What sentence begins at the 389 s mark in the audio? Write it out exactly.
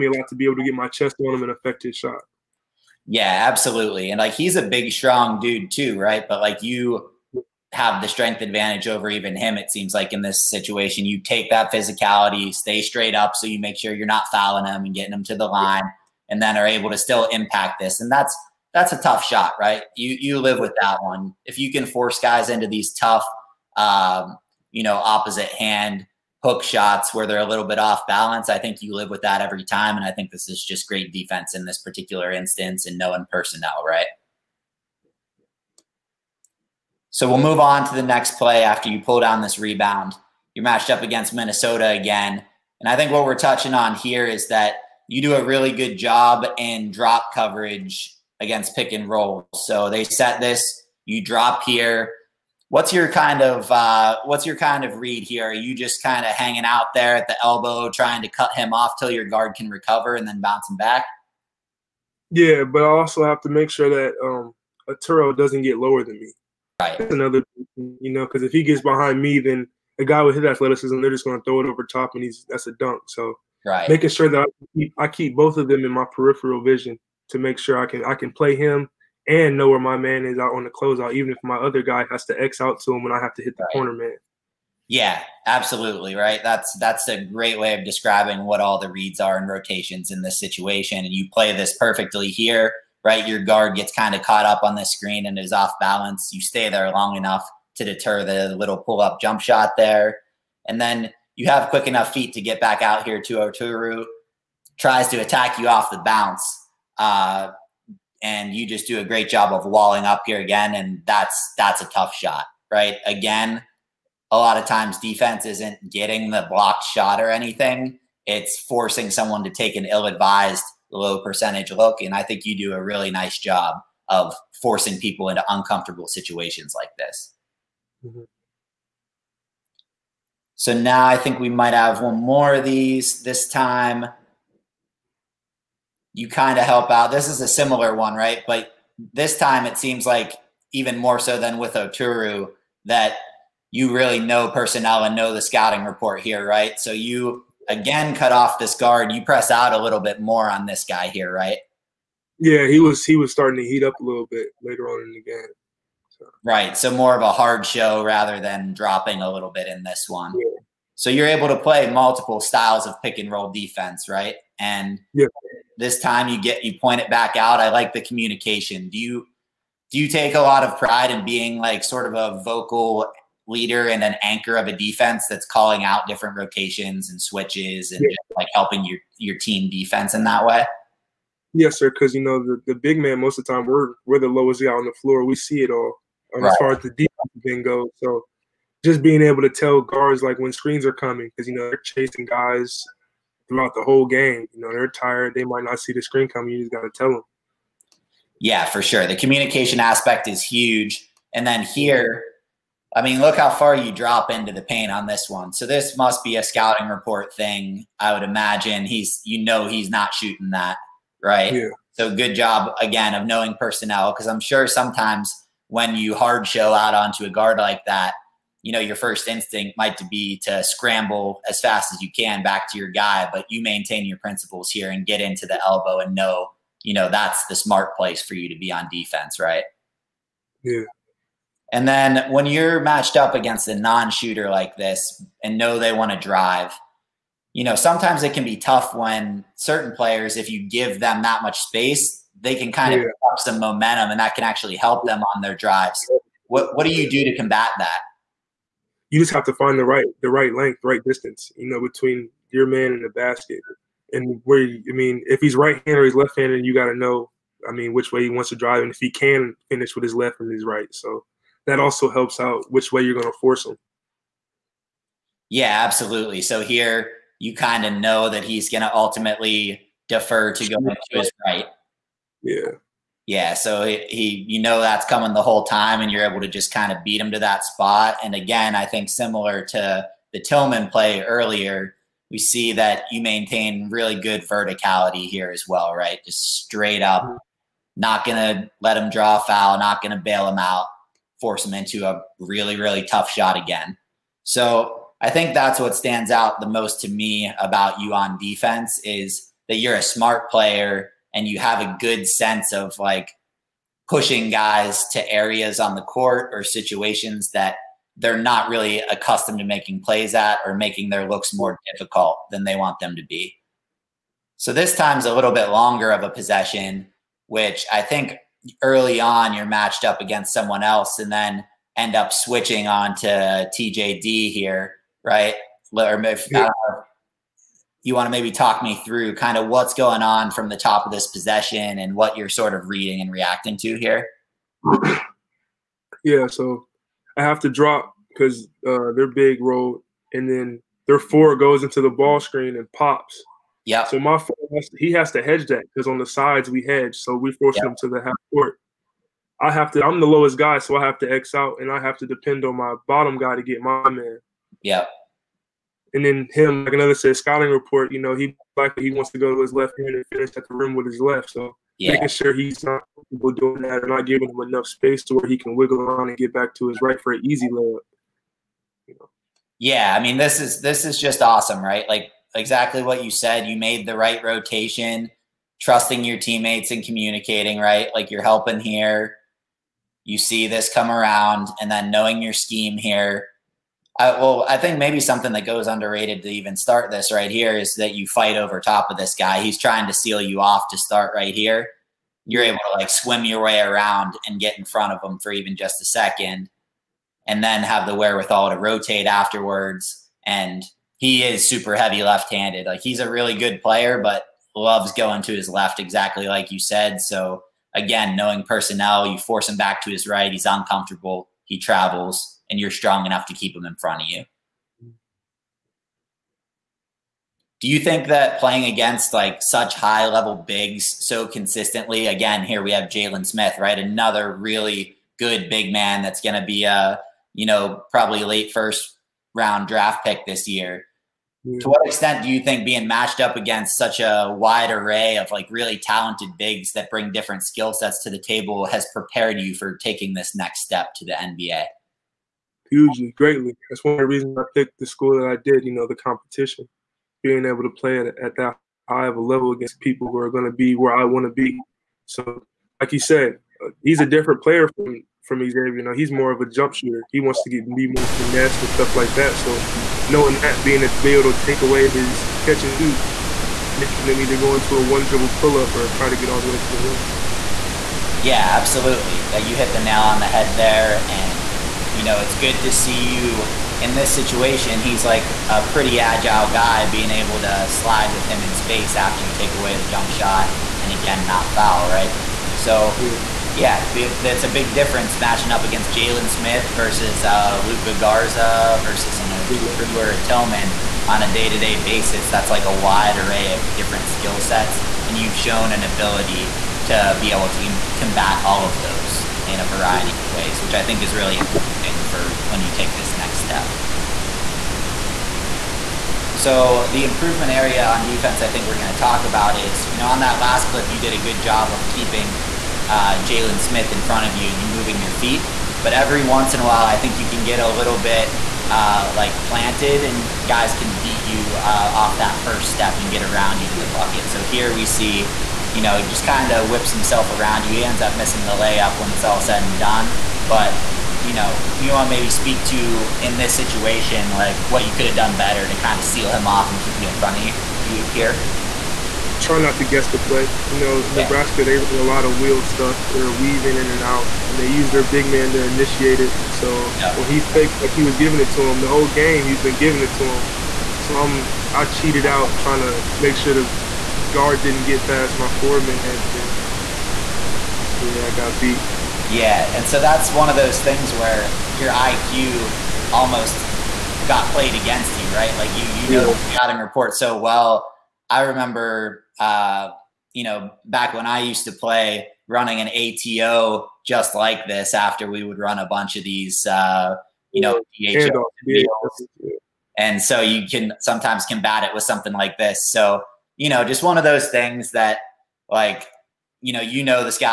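He's trying to seal you off to start right here.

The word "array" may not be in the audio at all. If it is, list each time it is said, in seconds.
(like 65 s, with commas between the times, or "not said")
434 s, 493 s.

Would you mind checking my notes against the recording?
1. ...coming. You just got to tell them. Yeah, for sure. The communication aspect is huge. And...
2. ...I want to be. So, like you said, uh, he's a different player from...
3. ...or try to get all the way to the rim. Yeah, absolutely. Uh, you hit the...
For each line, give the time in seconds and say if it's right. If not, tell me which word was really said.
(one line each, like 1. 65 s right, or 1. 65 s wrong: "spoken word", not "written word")
1. 196 s right
2. 451 s right
3. 465 s right.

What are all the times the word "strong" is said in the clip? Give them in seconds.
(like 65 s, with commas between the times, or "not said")
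4 s, 412 s.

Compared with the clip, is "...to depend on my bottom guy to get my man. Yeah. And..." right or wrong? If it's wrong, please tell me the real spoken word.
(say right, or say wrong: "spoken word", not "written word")
right.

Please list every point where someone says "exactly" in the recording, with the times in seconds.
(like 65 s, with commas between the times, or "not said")
372 s, 405 s.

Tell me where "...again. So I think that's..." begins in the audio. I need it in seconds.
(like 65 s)
293 s.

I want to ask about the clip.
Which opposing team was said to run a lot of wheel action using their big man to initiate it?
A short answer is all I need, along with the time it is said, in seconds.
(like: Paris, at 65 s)
Nebraska, at 541 s.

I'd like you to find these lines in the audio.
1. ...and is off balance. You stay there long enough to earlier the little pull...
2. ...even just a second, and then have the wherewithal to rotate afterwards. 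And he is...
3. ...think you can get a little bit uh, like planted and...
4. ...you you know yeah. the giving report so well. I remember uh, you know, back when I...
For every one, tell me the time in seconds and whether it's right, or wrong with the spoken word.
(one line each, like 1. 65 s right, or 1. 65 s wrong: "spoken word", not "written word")
1. 95 s wrong: "deter", not "earlier"
2. 395 s right
3. 517 s right
4. 565 s wrong: "scouting", not "giving".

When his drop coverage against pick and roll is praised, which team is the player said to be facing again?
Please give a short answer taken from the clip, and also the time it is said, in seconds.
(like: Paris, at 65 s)
Minnesota, at 41 s.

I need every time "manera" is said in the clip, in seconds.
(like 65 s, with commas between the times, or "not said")
not said.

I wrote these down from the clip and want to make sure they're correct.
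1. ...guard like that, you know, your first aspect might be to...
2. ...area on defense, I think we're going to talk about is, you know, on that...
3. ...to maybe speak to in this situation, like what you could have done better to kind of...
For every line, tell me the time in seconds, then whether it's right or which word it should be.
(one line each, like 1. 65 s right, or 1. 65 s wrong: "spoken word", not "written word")
1. 217 s wrong: "instinct", not "aspect"
2. 507 s right
3. 532 s right.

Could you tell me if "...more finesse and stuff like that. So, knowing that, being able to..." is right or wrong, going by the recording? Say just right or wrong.
right.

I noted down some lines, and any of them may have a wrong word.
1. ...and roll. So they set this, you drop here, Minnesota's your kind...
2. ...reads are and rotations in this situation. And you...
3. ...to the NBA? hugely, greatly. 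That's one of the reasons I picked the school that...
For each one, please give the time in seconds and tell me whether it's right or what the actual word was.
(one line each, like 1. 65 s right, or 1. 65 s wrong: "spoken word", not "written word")
1. 48 s wrong: "What", not "Minnesota"
2. 88 s right
3. 441 s right.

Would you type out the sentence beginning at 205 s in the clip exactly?
So this must be a scouting report thing.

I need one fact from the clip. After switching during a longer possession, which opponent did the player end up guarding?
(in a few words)
TJD.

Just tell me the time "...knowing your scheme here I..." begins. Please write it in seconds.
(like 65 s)
382 s.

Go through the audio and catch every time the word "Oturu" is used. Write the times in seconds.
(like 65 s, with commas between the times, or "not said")
64 s, 103 s, 141 s, 489 s.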